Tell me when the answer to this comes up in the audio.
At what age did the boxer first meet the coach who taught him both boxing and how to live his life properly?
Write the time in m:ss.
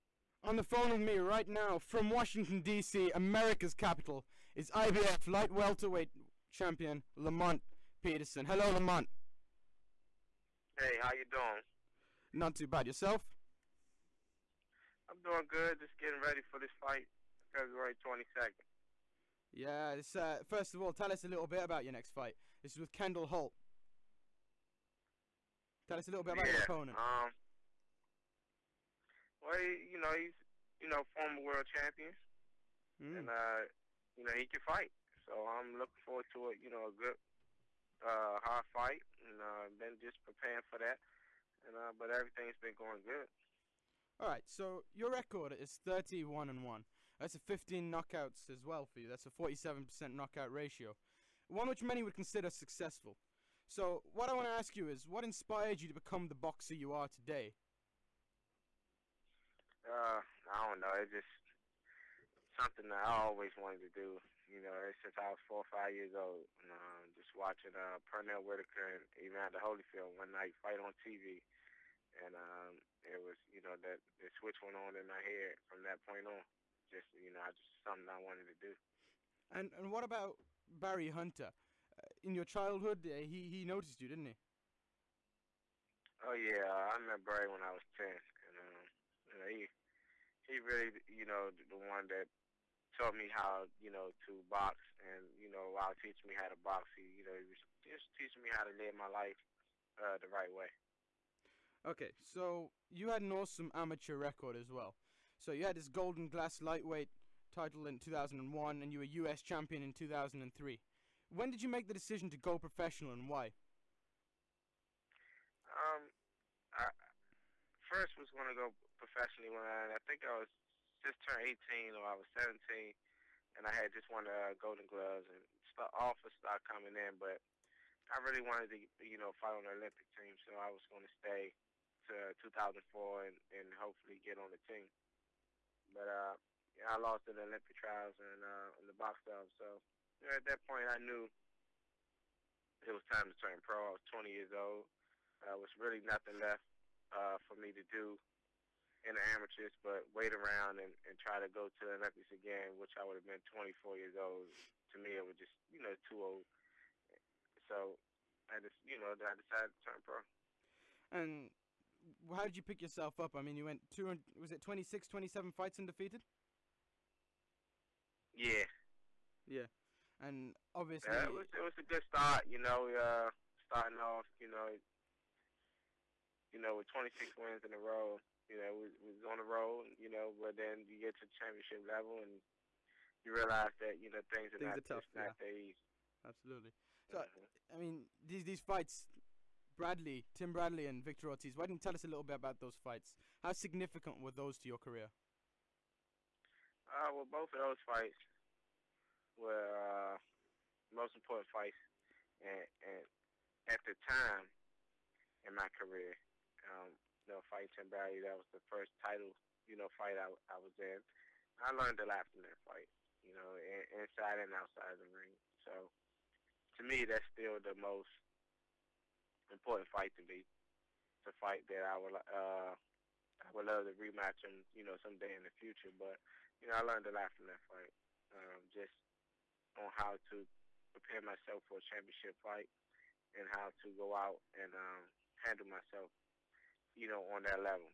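1:27.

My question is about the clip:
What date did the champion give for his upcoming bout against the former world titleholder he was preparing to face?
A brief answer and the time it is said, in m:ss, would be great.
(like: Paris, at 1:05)
February 22nd, at 0:17.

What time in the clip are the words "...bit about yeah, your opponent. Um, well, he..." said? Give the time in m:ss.
0:26.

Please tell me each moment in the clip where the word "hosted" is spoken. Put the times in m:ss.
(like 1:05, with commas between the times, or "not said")
not said.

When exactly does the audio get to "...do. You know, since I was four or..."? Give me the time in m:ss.
1:03.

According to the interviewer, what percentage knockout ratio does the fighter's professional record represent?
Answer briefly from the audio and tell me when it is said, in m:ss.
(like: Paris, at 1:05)
47%, at 0:49.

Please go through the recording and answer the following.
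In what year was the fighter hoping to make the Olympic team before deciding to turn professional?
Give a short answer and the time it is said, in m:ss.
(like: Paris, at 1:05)
2004, at 2:12.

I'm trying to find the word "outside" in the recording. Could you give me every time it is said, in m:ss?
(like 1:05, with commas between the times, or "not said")
3:34.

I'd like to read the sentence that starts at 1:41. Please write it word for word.
Okay, so you had an awesome amateur record as well.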